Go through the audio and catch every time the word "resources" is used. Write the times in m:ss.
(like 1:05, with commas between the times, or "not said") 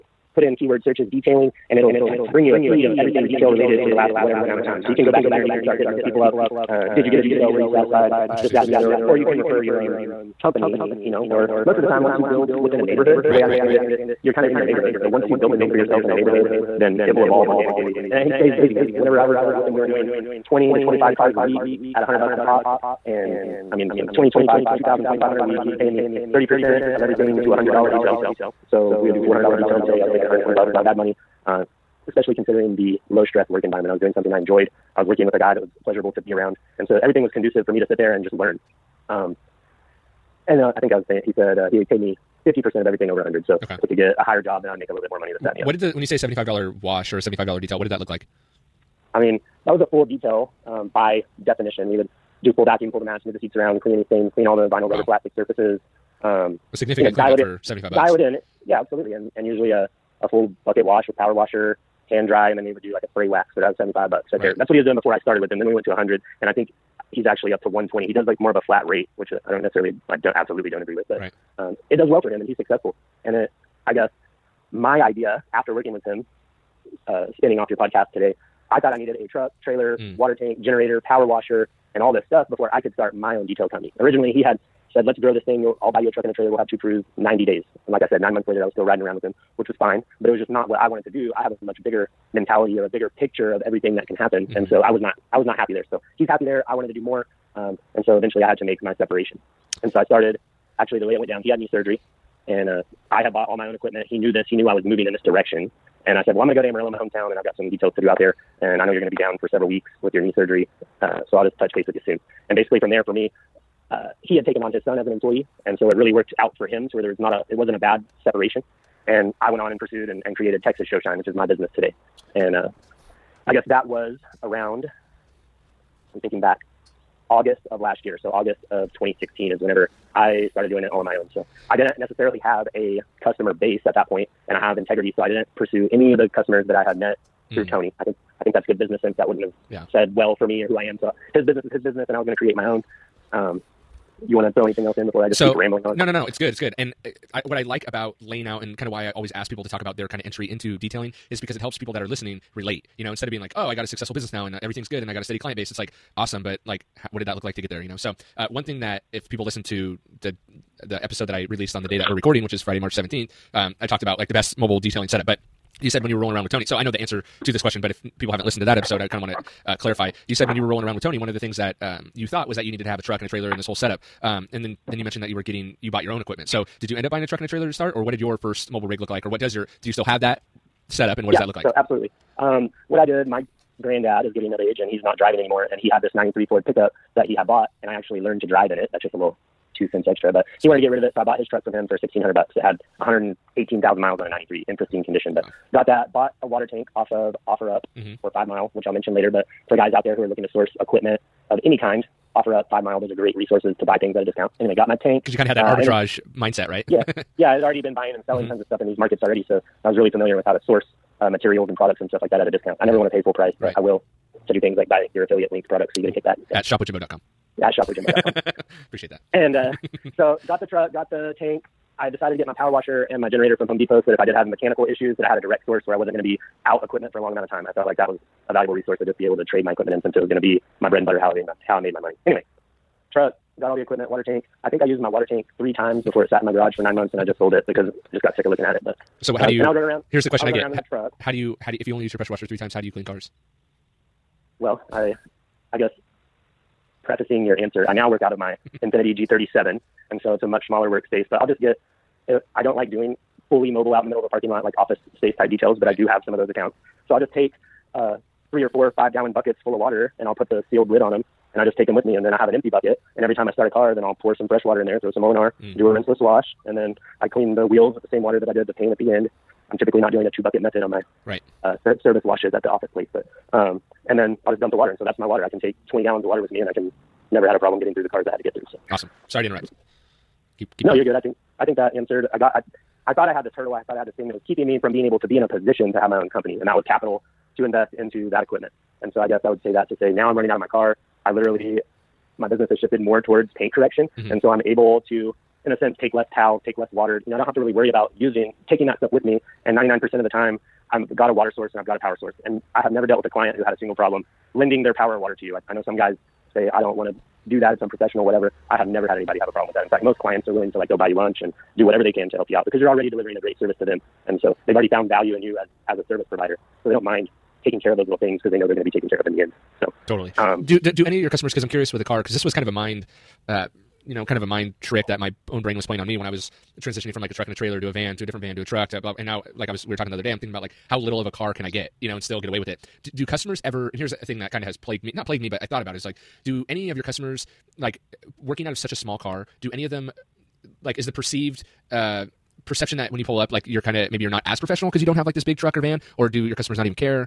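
3:23, 3:48.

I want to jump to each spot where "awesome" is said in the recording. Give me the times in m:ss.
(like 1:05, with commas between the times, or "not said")
2:36, 4:38.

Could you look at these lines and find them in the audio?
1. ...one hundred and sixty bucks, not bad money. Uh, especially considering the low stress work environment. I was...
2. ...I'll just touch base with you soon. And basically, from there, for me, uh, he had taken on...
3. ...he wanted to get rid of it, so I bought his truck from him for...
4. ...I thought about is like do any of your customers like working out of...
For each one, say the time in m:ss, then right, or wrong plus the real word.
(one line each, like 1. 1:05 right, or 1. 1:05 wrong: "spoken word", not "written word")
1. 0:30 wrong: "twenty", not "sixty"
2. 1:51 right
3. 3:10 right
4. 5:35 right.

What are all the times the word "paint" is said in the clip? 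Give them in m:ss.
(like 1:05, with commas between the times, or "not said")
4:28, 4:53.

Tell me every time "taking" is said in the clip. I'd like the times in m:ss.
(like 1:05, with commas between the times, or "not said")
4:58, 5:17.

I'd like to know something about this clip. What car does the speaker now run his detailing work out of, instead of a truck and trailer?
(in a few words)
Infinity G37.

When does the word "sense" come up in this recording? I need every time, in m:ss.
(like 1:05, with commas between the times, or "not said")
2:19, 4:55.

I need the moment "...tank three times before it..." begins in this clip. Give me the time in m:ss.
3:55.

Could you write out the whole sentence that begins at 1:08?
He does like more of a flat rate, which uh, I don't necessarily, I don't absolutely don't agree with, but.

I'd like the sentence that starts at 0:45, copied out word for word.
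What did the when you say seventy five dollar wash or seventy five dollar detail?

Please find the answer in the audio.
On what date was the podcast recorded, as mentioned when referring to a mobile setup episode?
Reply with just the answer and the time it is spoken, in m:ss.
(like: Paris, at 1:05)
Friday, March 17th, at 2:42.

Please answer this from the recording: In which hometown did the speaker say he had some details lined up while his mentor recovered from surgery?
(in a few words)
Amarillo.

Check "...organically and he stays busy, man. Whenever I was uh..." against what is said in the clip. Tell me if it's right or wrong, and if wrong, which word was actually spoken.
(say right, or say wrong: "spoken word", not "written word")
right.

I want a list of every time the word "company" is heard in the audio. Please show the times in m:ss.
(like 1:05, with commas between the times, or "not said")
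0:10, 1:23, 4:46.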